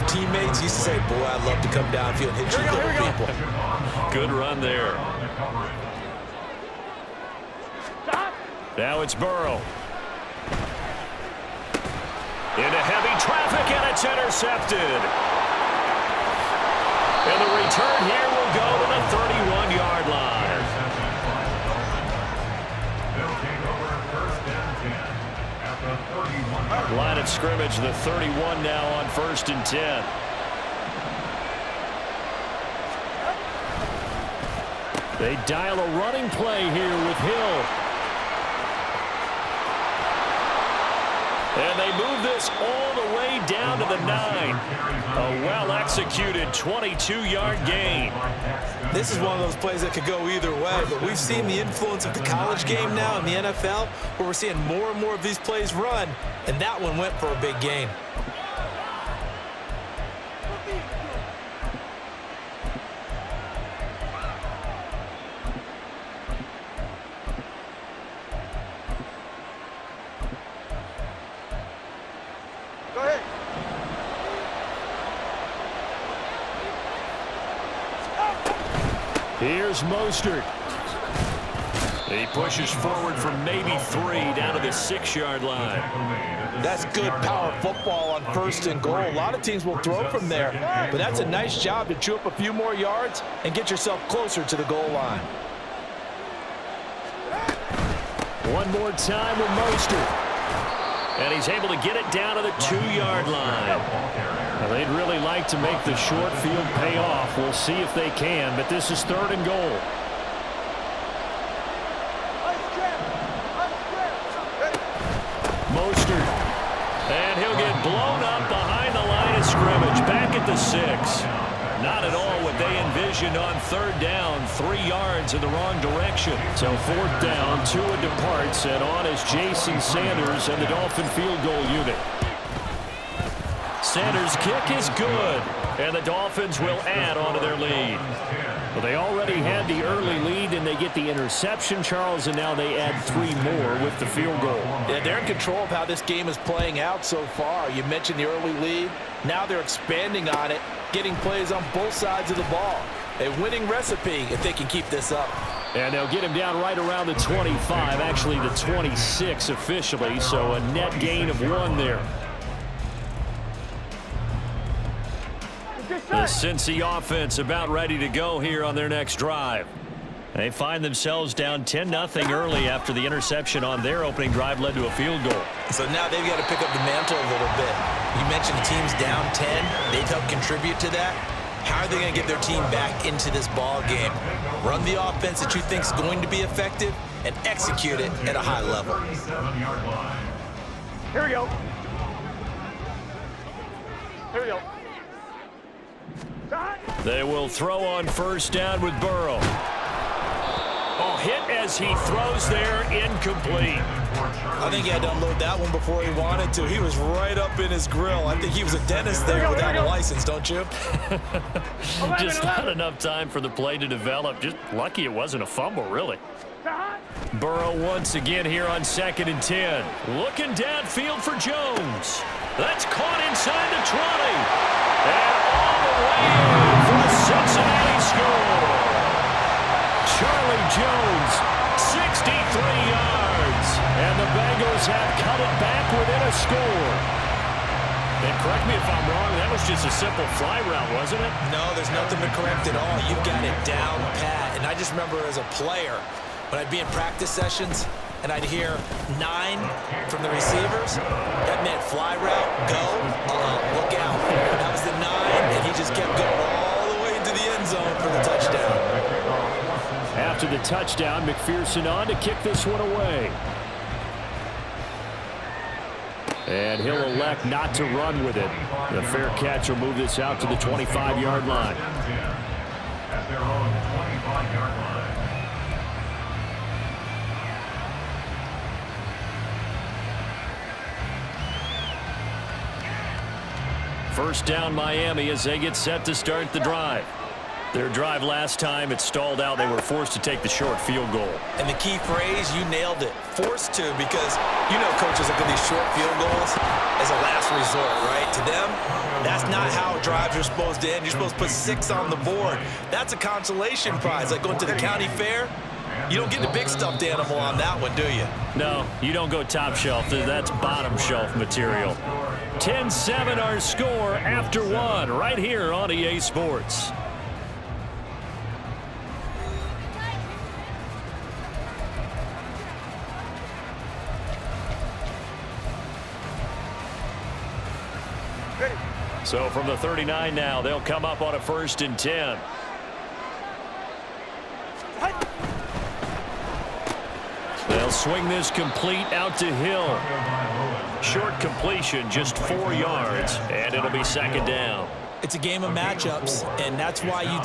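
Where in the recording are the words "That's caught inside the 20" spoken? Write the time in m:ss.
3:42.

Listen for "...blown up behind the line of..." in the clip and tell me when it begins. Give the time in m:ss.
1:57.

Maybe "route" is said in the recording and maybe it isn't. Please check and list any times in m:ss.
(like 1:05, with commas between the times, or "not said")
4:00, 4:12.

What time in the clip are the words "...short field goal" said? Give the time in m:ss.
4:50.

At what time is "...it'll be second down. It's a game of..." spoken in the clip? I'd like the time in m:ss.
5:43.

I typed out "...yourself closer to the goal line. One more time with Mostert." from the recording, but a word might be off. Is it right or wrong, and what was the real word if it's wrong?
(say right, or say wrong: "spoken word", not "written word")
right.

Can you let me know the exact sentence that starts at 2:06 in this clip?
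So fourth down, Tua departs, and on is Jason Sanders and the Dolphin field goal unit.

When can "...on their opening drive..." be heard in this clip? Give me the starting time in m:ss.
2:53.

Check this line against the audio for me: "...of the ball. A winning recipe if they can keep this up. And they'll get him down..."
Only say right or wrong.
right.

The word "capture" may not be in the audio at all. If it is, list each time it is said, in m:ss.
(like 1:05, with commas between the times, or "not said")
not said.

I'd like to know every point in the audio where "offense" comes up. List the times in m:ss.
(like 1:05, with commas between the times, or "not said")
2:46, 3:04.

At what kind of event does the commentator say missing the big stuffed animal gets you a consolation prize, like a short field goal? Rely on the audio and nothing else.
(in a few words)
county fair.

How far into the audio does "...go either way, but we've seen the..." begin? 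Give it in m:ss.
0:50.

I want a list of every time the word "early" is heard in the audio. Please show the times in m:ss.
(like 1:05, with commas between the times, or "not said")
2:19, 2:28, 2:52.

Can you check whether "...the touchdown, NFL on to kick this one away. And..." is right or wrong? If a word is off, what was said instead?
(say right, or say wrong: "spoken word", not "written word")
wrong: "McPherson", not "NFL".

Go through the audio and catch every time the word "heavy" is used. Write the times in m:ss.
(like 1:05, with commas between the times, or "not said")
0:12.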